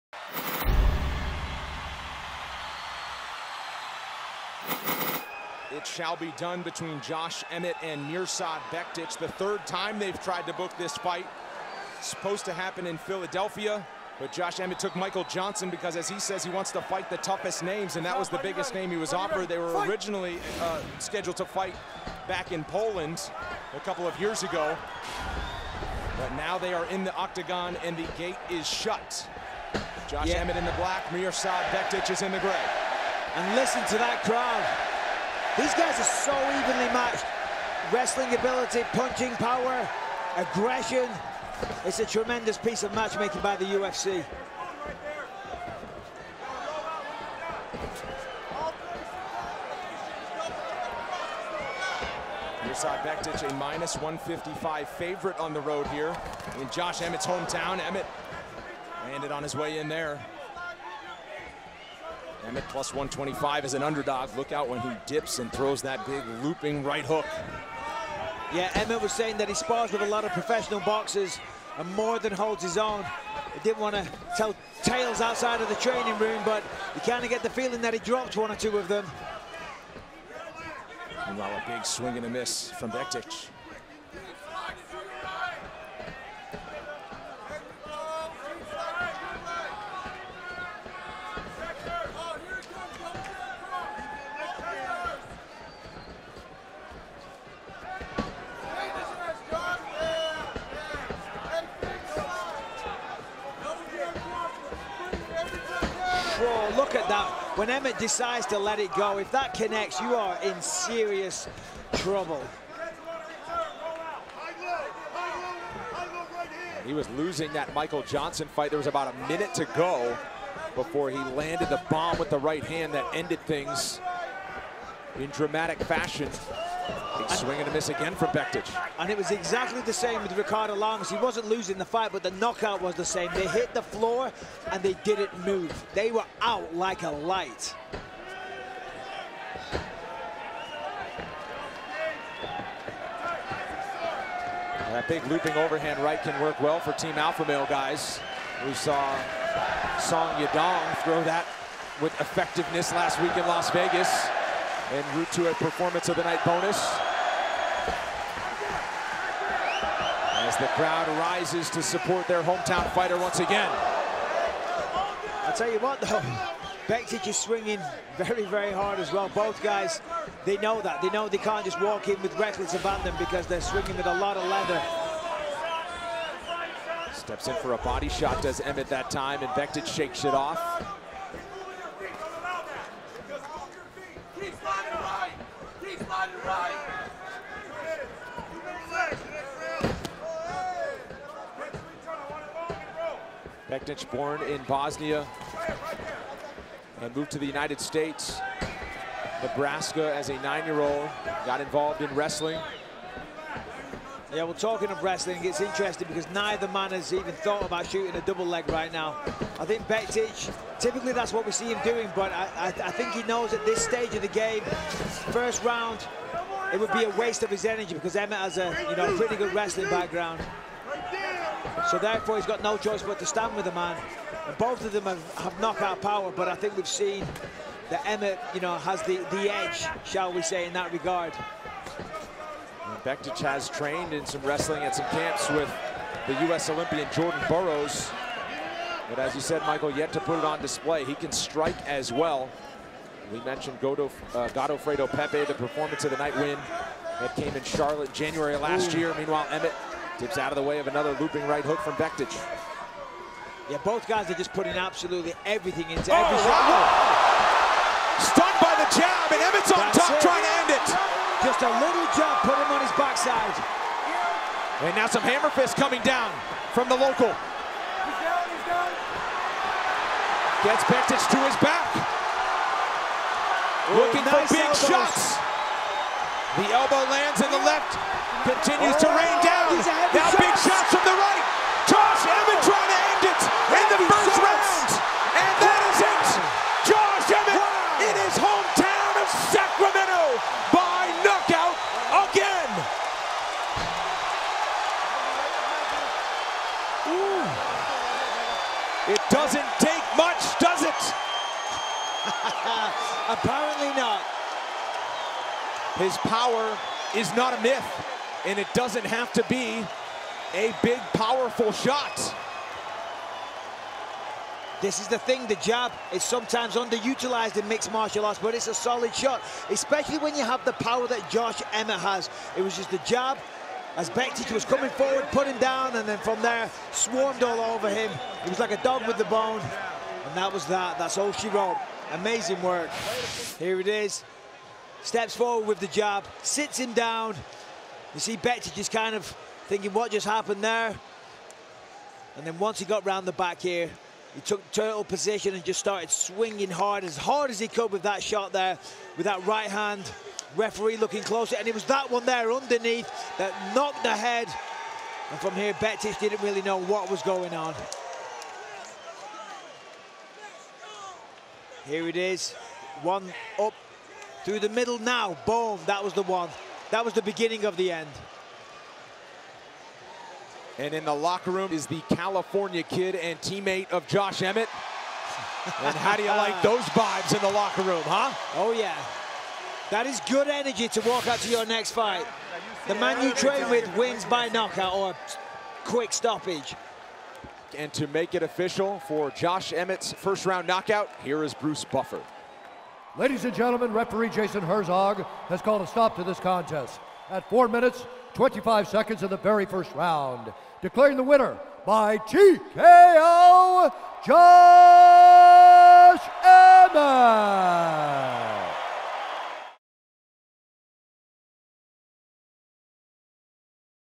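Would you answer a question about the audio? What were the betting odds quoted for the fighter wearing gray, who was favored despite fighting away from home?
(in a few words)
-155.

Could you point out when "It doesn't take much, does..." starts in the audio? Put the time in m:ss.
4:59.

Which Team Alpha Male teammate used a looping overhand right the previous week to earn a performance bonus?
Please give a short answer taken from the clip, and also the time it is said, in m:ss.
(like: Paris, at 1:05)
Song Yadong, at 2:29.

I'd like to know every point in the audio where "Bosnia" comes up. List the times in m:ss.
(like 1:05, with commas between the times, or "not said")
3:14.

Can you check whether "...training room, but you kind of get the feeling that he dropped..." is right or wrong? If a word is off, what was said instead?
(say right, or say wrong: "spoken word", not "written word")
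right.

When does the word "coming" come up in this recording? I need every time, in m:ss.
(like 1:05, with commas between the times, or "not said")
4:25, 5:24.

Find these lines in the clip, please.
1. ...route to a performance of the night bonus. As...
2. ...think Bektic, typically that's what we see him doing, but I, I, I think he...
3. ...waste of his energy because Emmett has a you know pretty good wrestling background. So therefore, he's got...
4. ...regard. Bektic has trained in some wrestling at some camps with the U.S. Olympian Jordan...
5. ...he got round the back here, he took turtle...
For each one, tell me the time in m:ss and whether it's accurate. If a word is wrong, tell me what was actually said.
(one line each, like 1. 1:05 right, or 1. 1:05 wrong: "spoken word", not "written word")
1. 2:35 right
2. 3:29 right
3. 3:37 right
4. 3:50 right
5. 5:42 right.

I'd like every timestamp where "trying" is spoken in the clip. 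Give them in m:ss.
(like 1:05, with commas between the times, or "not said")
4:20, 4:42.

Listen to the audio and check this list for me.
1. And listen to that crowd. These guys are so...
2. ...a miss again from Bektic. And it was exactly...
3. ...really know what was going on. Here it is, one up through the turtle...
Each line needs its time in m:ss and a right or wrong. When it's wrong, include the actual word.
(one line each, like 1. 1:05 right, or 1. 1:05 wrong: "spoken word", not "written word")
1. 0:33 right
2. 2:07 right
3. 5:56 wrong: "middle", not "turtle".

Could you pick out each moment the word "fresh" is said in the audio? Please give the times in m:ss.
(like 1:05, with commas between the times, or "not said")
not said.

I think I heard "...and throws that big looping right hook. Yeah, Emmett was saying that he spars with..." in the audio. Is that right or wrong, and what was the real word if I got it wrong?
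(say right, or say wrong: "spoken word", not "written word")
right.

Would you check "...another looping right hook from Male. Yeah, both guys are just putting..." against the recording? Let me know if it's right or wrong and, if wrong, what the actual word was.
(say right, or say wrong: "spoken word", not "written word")
wrong: "Bektic", not "Male".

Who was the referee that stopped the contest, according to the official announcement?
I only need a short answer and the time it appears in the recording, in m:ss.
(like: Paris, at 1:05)
Jason Herzog, at 6:34.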